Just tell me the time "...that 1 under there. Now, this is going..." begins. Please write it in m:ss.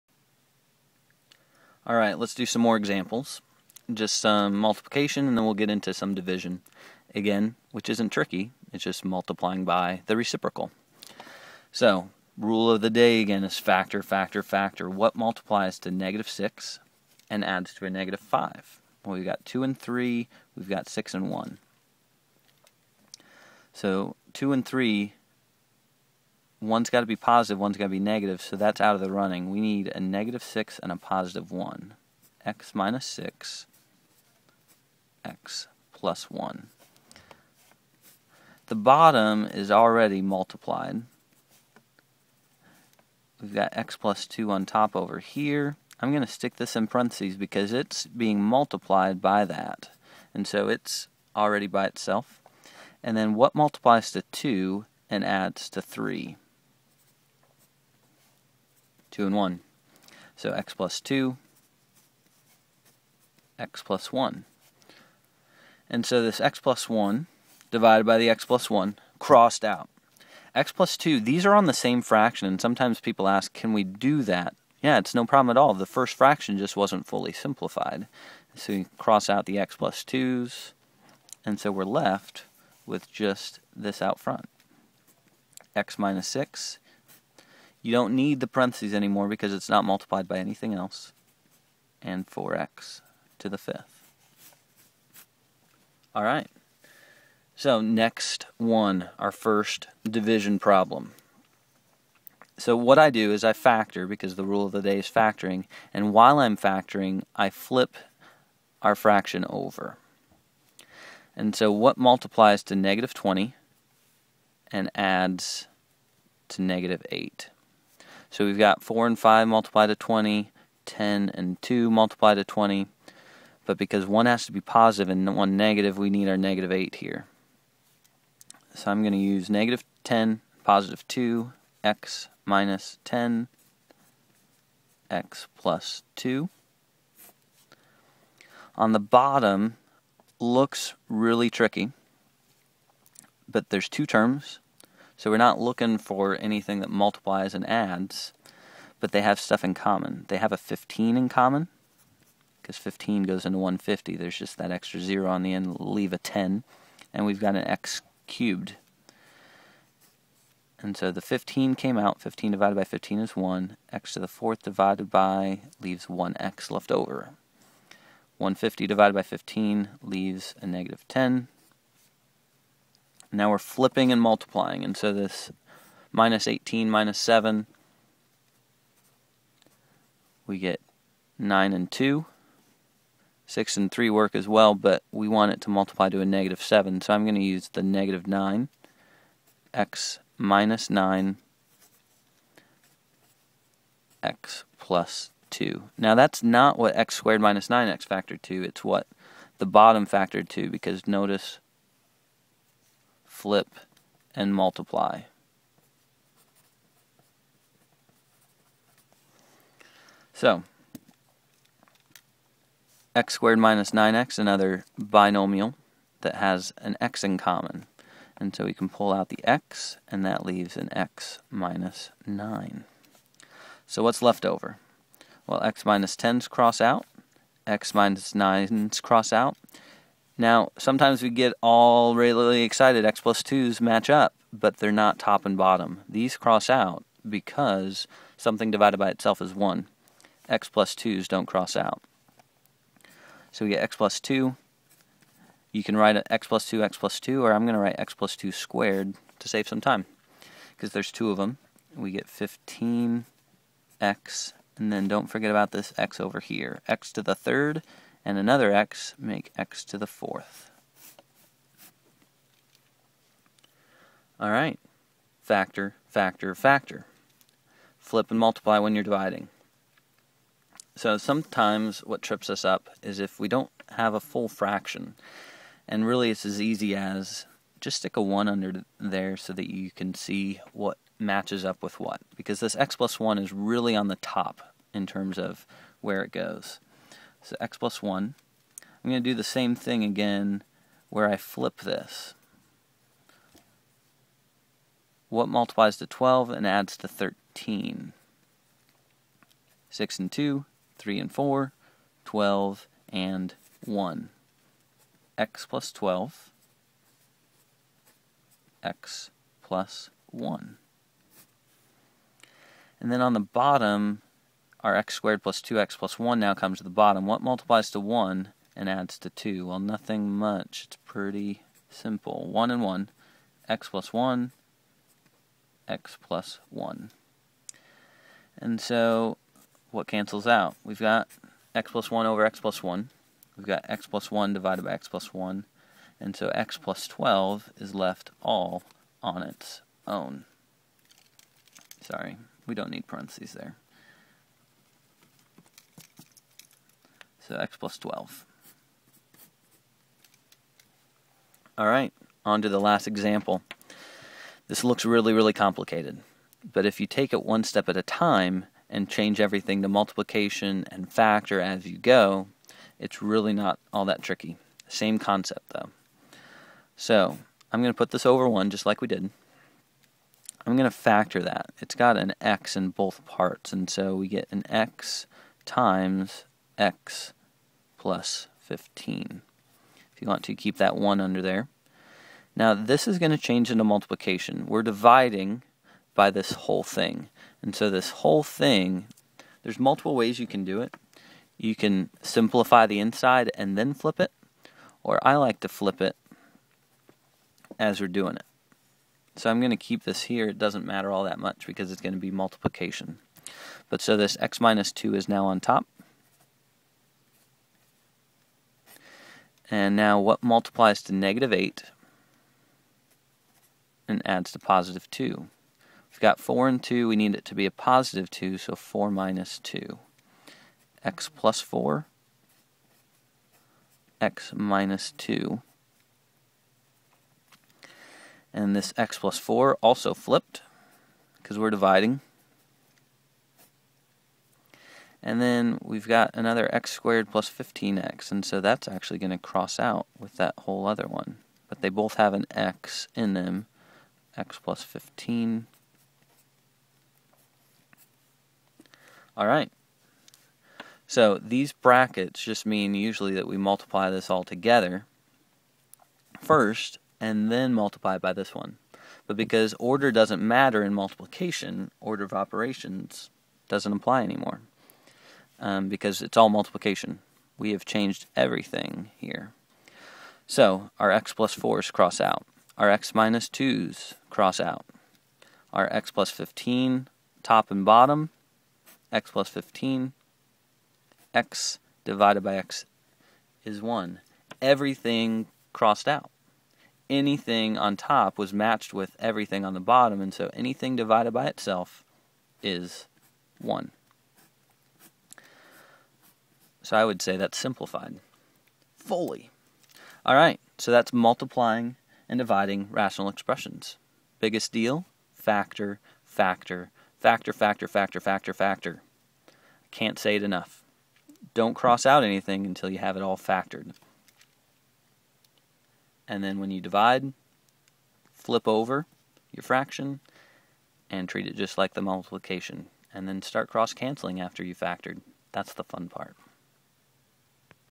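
6:20.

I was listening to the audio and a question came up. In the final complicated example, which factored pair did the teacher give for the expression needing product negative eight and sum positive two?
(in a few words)
x + 4 and x - 2.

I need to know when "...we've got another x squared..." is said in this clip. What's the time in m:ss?
7:15.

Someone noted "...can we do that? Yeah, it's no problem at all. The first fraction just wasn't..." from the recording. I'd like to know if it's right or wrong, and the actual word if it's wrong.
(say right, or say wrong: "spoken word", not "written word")
right.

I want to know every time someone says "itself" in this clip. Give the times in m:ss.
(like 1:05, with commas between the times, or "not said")
0:51, 3:59, 8:11.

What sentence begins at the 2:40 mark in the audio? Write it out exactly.
And so the 15 came out, 15 divided by 15 is 1, x to the 4th divided by leaves 1x left over.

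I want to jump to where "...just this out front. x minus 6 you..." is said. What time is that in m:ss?
1:23.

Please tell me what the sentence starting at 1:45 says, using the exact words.
And while I'm factoring, I flip our fraction over.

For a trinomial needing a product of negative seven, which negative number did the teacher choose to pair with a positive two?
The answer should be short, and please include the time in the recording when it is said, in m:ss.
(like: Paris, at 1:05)
-9, at 3:07.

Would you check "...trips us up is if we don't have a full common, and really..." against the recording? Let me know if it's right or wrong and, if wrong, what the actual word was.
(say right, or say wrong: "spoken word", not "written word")
wrong: "fraction", not "common".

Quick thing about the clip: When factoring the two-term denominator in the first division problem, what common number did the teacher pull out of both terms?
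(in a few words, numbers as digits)
15.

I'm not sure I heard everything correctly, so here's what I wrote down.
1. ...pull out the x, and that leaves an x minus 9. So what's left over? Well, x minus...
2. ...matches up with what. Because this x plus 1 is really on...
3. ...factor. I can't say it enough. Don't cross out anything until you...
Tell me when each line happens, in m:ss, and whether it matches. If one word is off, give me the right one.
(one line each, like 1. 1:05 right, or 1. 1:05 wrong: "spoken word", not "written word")
1. 3:38 right
2. 4:41 right
3. 8:28 right.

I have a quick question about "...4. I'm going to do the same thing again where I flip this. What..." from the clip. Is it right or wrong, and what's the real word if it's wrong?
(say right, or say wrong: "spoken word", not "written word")
wrong: "1", not "4".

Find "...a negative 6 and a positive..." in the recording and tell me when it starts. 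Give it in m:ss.
0:29.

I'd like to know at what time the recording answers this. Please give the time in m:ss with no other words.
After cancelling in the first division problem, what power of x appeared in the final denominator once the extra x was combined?
4:19.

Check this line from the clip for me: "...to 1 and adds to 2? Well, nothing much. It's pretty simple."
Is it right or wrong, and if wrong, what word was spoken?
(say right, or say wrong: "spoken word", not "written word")
right.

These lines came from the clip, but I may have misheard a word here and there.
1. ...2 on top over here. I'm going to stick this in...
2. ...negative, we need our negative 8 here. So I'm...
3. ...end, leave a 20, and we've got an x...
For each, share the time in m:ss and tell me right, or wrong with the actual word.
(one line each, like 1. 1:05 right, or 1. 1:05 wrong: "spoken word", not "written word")
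1. 0:44 right
2. 2:05 right
3. 2:35 wrong: "10", not "20".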